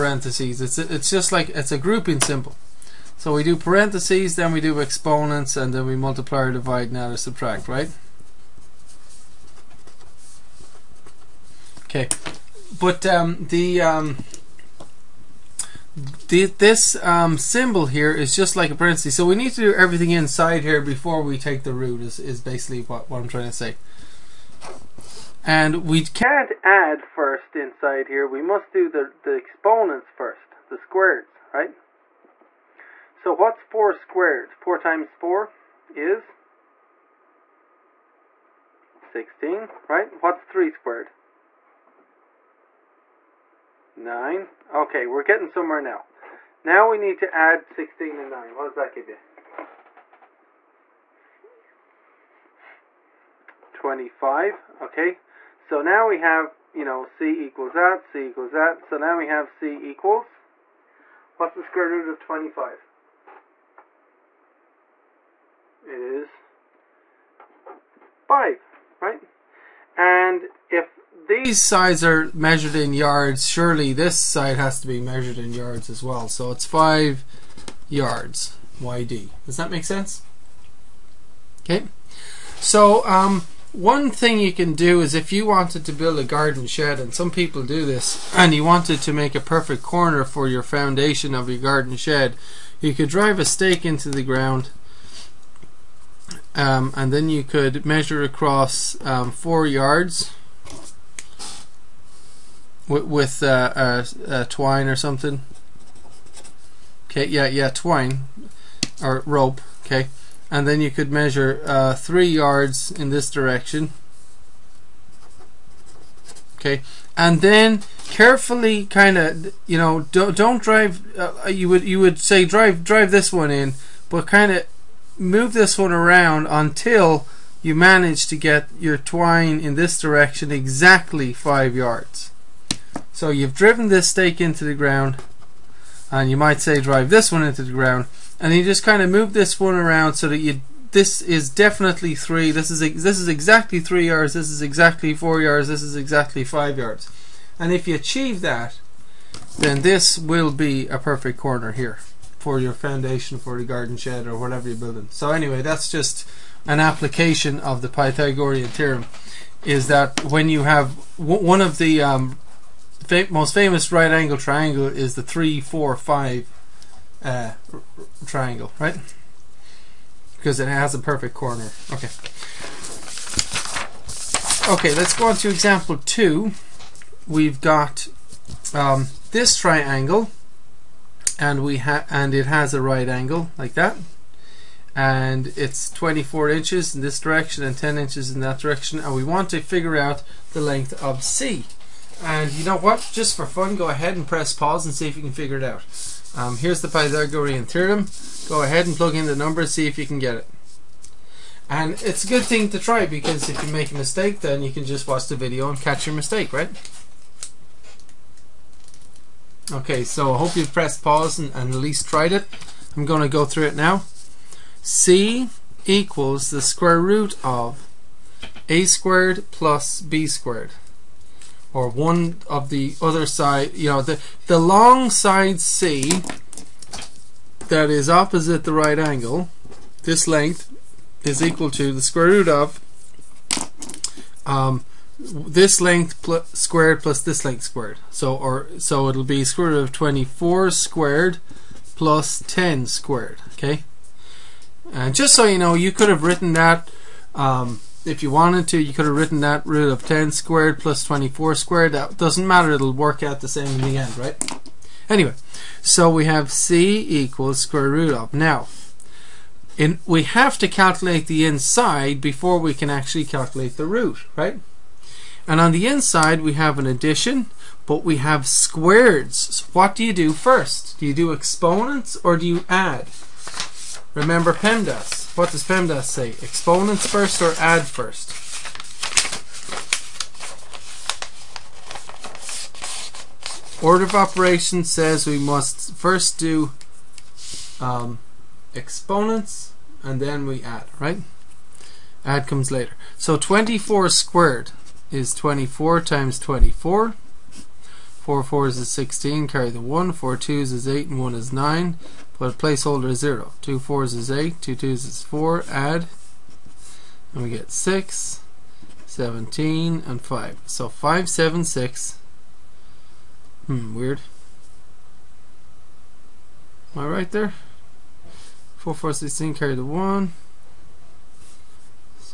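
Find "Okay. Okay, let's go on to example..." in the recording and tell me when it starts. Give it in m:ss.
2:51.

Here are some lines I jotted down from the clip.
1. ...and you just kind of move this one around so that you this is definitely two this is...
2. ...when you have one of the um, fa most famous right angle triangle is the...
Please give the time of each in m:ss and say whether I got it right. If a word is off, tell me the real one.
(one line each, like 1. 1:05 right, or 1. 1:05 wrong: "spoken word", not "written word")
1. 2:18 wrong: "three", not "two"
2. 2:40 right.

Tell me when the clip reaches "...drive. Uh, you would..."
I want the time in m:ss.
2:00.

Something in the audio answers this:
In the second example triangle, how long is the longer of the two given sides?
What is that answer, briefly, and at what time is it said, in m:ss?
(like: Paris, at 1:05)
24 inches, at 3:05.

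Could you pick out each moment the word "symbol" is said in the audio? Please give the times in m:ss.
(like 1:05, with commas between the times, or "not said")
0:02, 0:17.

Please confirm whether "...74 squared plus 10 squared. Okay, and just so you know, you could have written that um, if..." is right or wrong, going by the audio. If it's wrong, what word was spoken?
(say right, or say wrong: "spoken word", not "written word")
wrong: "24", not "74".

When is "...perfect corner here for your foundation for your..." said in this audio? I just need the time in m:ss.
2:30.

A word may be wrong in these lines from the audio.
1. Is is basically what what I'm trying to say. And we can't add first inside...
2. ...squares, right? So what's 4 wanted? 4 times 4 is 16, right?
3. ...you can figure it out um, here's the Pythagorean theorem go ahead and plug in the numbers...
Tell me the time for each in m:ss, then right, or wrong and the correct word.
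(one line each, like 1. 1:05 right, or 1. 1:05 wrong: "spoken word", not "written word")
1. 0:22 right
2. 0:30 wrong: "squared", not "wanted"
3. 3:15 right.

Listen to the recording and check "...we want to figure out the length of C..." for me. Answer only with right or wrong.
right.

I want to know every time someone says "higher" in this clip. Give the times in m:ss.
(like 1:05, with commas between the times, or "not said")
not said.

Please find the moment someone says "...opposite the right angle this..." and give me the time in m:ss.
3:48.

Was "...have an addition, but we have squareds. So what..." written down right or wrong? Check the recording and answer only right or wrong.
right.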